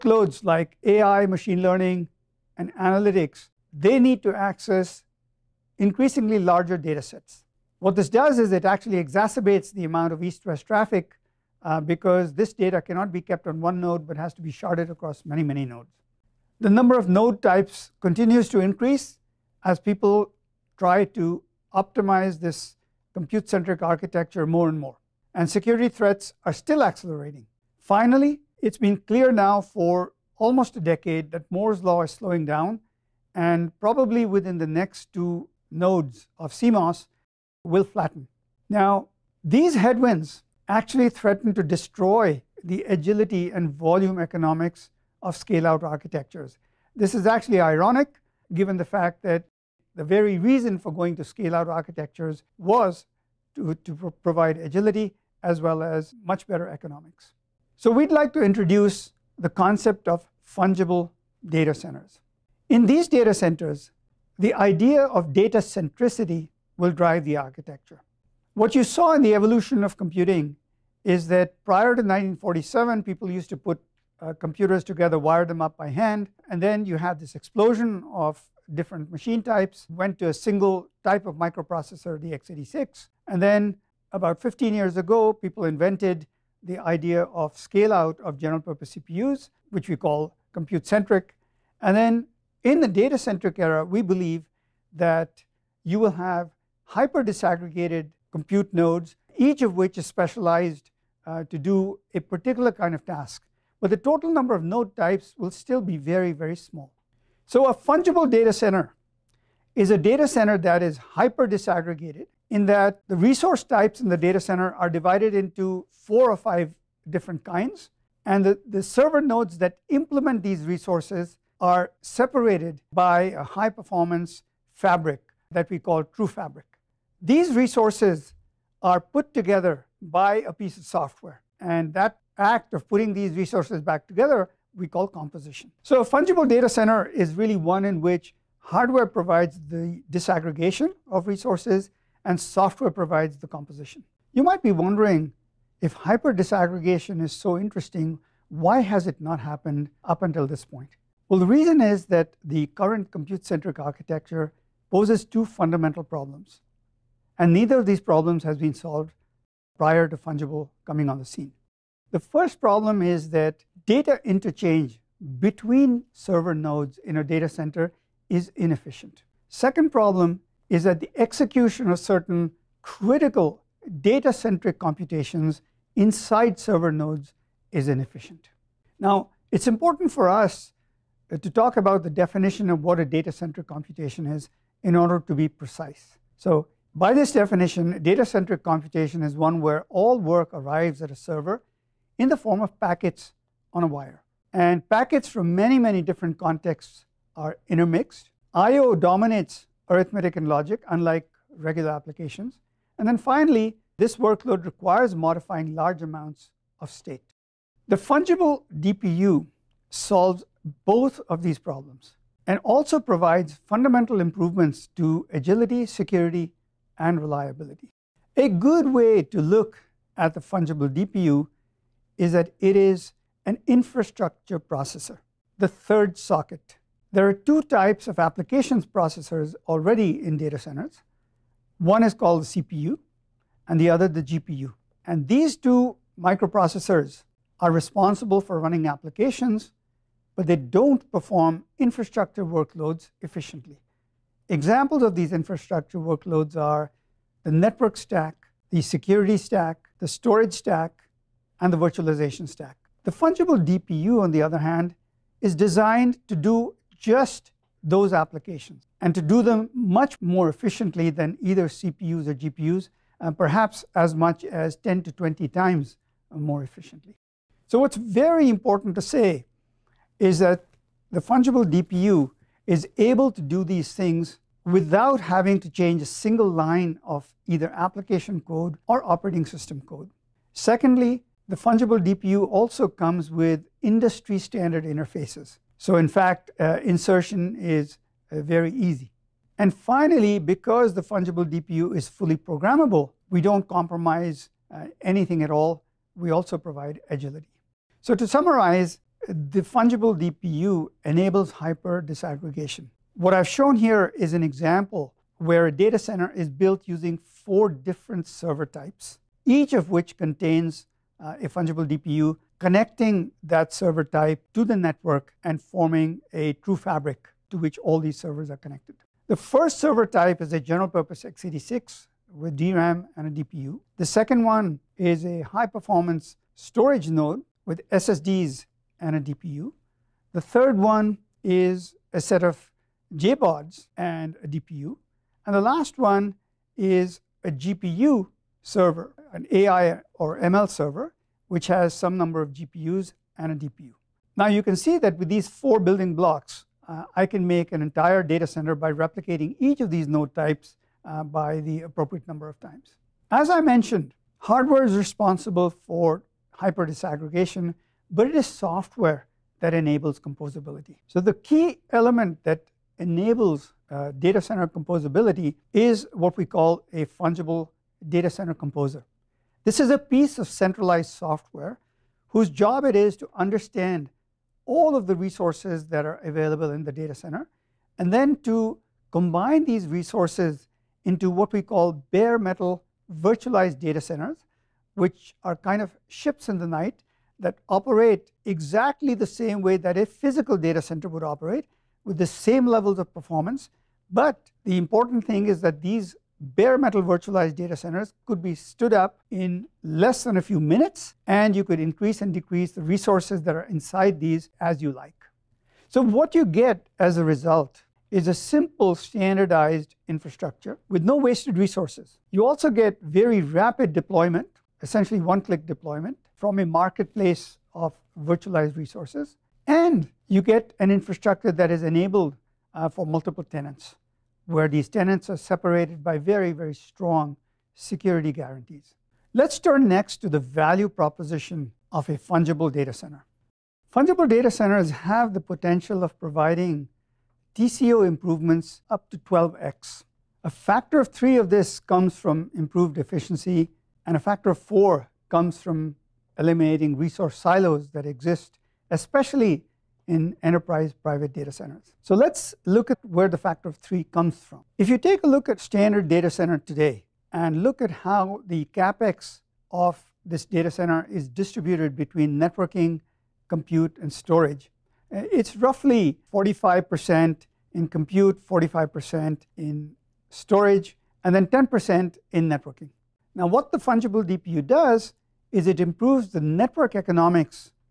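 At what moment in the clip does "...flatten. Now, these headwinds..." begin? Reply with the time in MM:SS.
00:37.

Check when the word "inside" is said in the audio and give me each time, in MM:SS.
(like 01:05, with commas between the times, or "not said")
02:55, 06:43.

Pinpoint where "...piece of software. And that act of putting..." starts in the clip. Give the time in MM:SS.
02:10.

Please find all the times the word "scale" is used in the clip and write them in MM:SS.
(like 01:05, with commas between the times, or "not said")
00:45, 00:51, 01:27.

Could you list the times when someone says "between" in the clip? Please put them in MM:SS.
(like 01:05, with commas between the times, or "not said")
02:45, 07:41.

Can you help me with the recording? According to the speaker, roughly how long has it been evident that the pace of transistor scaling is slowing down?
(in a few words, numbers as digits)
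almost a decade.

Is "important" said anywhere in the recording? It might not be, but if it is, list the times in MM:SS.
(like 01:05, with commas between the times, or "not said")
02:59, 04:28, 06:34.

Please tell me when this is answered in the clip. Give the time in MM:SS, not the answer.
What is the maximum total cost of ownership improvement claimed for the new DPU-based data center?
07:19.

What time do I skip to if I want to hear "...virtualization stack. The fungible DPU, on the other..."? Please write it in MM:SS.
04:11.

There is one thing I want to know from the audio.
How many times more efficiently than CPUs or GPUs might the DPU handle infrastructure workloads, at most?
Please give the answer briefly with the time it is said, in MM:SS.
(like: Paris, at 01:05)
10 to 20 times, at 04:24.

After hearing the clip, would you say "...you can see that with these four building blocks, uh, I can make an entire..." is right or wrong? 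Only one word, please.
right.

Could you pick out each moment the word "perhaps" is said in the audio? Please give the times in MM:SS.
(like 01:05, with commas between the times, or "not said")
04:23.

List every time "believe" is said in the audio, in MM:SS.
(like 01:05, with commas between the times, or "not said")
01:34.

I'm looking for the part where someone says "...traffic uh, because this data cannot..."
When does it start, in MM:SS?
00:10.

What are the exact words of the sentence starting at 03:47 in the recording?
There are two types of applications processors already in data centers.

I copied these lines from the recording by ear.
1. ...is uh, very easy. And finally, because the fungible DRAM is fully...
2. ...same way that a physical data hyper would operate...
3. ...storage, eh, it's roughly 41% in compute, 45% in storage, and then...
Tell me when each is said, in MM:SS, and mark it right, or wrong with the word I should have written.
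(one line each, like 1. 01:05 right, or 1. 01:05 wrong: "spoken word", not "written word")
1. 04:47 wrong: "DPU", not "DRAM"
2. 06:29 wrong: "center", not "hyper"
3. 07:44 wrong: "45", not "41".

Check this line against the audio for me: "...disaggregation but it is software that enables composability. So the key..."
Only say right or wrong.
right.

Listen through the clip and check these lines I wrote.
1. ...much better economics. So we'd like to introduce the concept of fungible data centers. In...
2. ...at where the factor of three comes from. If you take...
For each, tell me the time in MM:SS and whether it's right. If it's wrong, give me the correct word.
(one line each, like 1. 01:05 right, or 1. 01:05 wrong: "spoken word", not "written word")
1. 00:56 right
2. 07:32 right.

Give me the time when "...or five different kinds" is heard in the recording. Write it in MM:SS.
01:56.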